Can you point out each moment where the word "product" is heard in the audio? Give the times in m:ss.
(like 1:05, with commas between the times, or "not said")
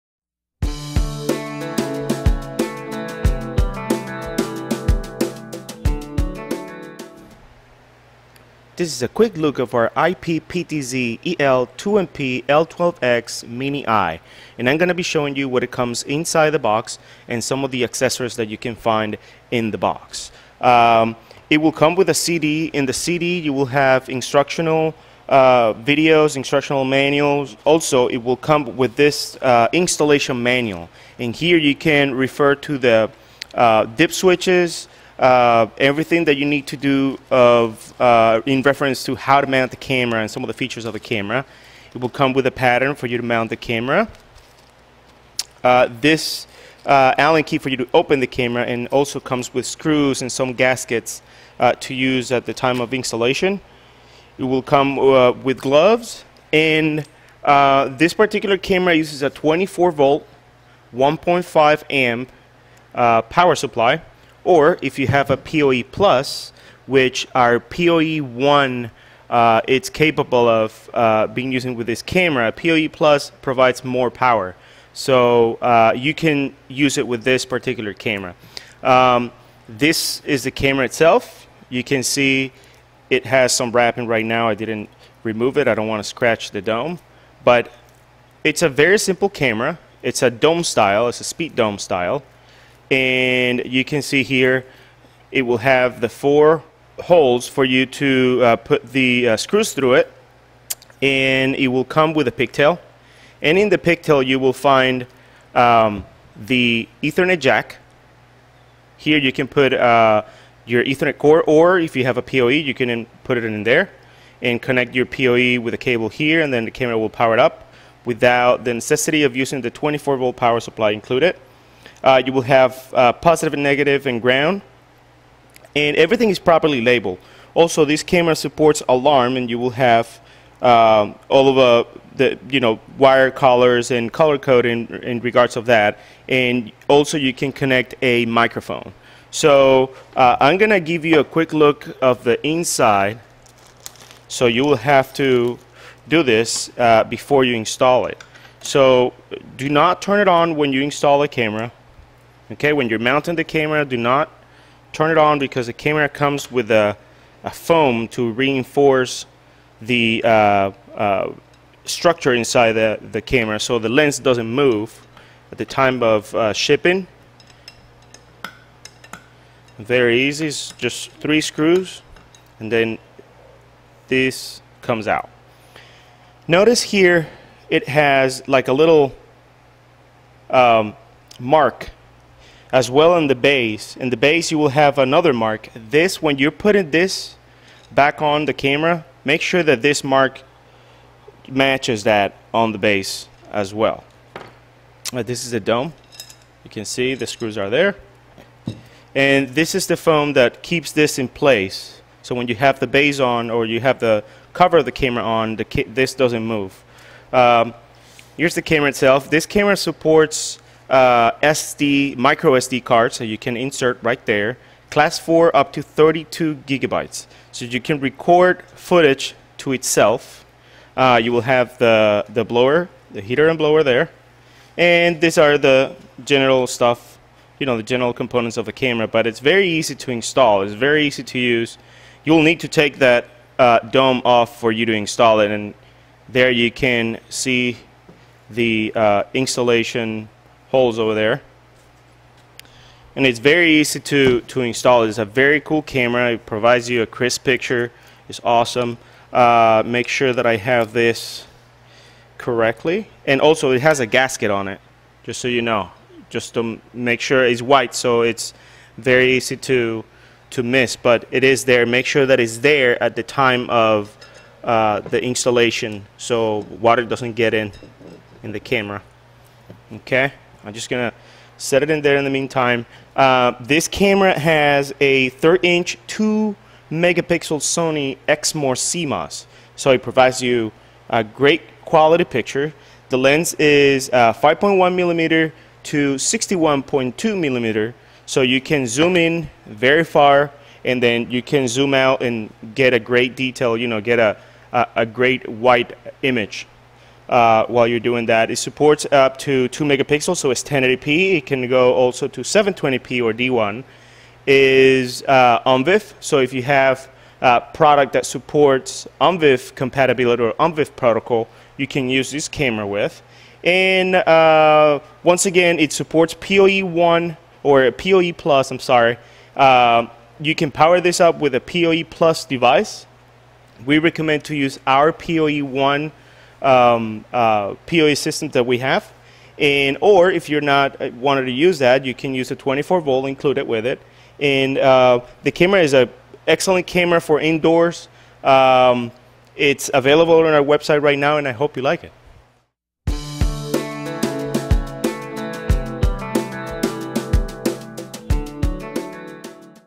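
5:07.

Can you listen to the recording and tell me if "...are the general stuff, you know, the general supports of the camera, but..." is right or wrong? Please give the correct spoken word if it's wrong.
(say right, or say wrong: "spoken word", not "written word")
wrong: "components", not "supports".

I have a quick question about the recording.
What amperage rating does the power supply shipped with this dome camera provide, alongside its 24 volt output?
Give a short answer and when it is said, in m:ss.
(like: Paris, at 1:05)
1.5 amp, at 1:00.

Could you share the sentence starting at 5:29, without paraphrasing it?
And, or if you're not uh, wanted to use that, you can use a 24 volt included with it.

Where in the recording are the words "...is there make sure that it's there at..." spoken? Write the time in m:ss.
4:21.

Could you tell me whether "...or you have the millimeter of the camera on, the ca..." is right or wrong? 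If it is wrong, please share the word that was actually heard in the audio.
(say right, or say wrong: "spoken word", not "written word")
wrong: "cover", not "millimeter".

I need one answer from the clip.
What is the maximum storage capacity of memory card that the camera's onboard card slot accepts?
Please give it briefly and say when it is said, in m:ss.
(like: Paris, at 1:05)
32 gigabytes, at 3:35.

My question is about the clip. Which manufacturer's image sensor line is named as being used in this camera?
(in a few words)
Sony Exmor.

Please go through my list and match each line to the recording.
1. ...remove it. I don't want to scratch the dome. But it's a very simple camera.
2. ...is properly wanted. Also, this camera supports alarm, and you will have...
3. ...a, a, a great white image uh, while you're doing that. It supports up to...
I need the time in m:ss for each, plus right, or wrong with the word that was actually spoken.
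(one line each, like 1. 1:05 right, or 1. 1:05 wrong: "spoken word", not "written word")
1. 1:25 right
2. 2:06 wrong: "labeled", not "wanted"
3. 4:54 right.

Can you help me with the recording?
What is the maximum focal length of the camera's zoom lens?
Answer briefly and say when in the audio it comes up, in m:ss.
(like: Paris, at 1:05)
61.2 millimeter, at 4:46.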